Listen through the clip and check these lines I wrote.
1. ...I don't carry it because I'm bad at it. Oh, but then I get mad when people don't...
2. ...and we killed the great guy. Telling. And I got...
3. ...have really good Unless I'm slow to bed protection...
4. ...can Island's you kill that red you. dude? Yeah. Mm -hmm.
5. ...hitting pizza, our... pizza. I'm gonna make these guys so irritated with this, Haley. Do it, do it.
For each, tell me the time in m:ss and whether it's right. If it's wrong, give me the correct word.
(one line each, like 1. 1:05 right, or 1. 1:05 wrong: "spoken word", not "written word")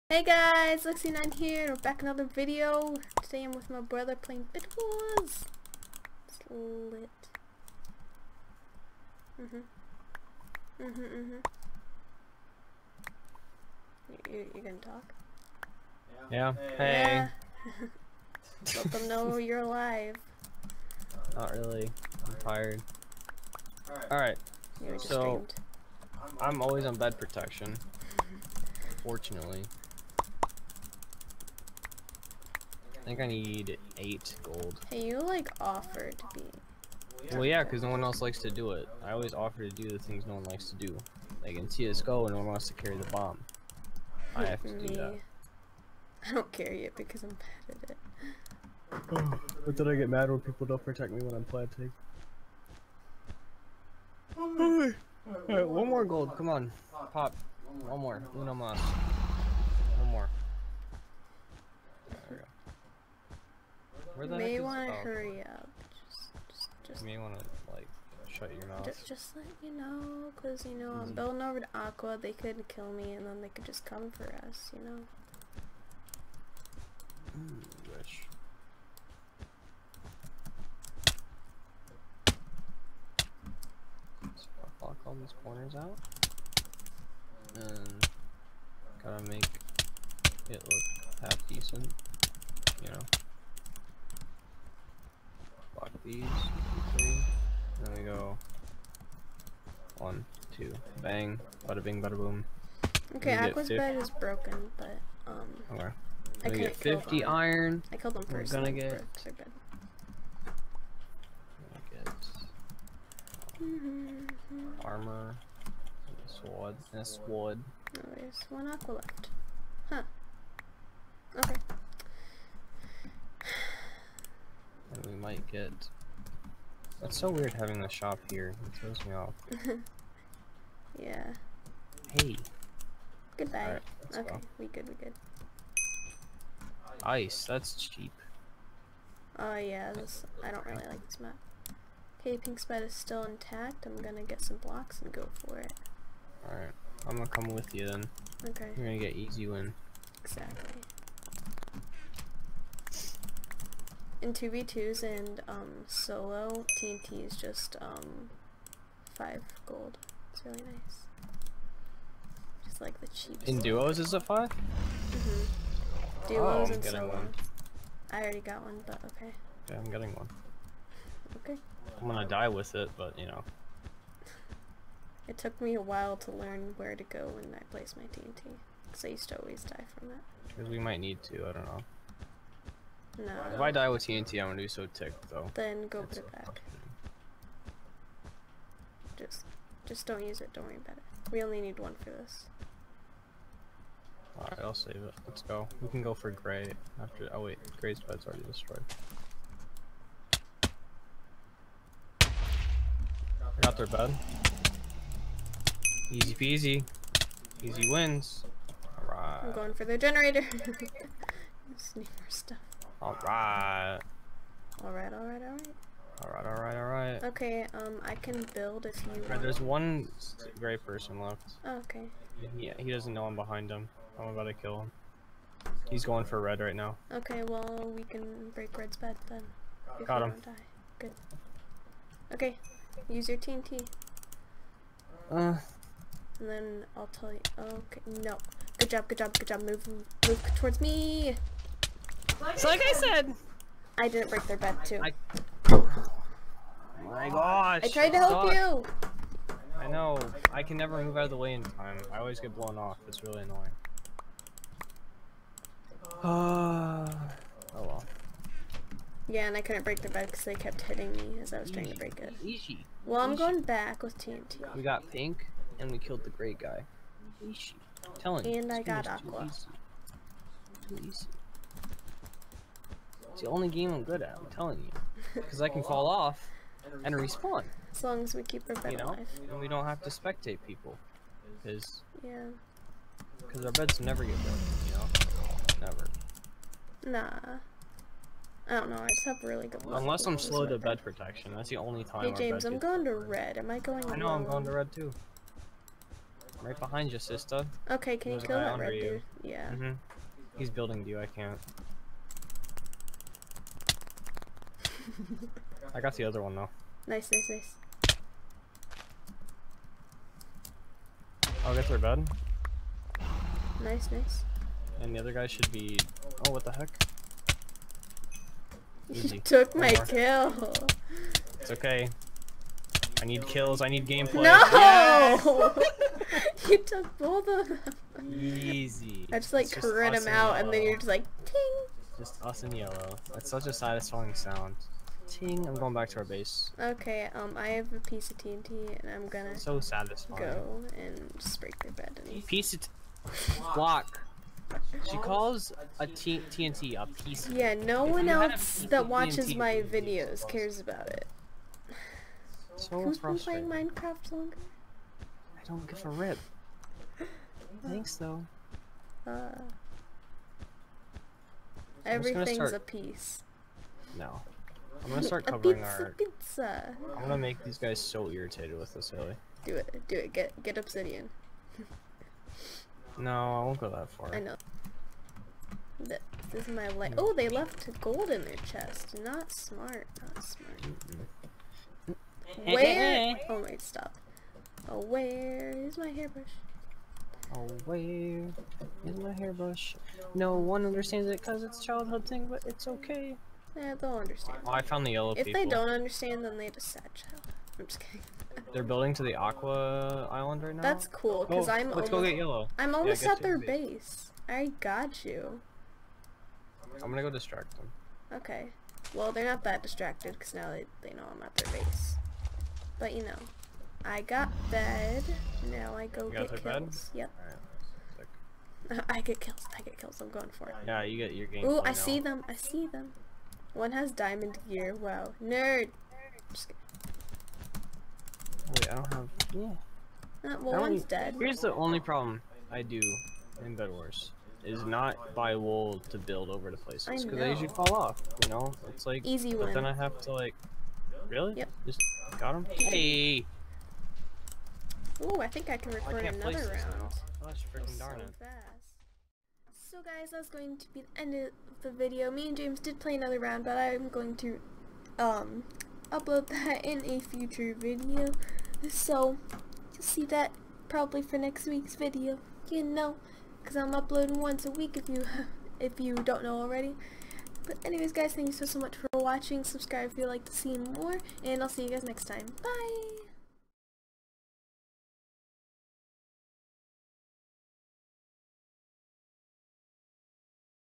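1. 0:46 right
2. 4:25 right
3. 4:49 right
4. 4:58 wrong: "There", not "Island"
5. 6:05 wrong: "covering", not "hitting".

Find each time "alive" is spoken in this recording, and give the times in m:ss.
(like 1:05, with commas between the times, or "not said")
0:19, 4:39.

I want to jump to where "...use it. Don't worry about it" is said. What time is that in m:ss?
3:10.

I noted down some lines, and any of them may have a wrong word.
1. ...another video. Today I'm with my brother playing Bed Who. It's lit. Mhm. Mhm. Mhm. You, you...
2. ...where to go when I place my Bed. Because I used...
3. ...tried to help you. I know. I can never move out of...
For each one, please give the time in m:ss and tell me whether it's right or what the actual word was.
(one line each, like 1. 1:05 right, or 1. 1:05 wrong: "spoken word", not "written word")
1. 0:02 wrong: "Wars", not "Who"
2. 2:56 wrong: "TNT", not "Bed"
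3. 4:07 right.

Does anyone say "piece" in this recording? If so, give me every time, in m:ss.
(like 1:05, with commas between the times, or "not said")
5:37, 5:42, 5:47, 6:02.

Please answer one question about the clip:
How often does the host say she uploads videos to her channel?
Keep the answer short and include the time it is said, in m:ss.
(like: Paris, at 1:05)
once a week, at 7:44.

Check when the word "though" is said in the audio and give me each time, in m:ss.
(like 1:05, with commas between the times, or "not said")
3:05, 5:06, 5:58.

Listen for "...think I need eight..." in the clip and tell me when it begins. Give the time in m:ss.
0:33.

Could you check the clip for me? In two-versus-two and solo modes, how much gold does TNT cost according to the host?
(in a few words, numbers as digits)
5 gold.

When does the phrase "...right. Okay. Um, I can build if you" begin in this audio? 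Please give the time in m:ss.
3:36.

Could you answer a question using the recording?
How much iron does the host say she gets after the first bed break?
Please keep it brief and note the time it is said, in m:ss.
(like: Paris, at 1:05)
50, at 1:46.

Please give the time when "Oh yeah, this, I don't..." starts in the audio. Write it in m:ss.
2:19.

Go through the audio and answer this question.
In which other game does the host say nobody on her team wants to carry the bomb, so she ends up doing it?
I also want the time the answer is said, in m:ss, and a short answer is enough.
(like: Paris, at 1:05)
CSGO, at 0:41.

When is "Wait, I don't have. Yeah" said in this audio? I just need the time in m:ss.
7:05.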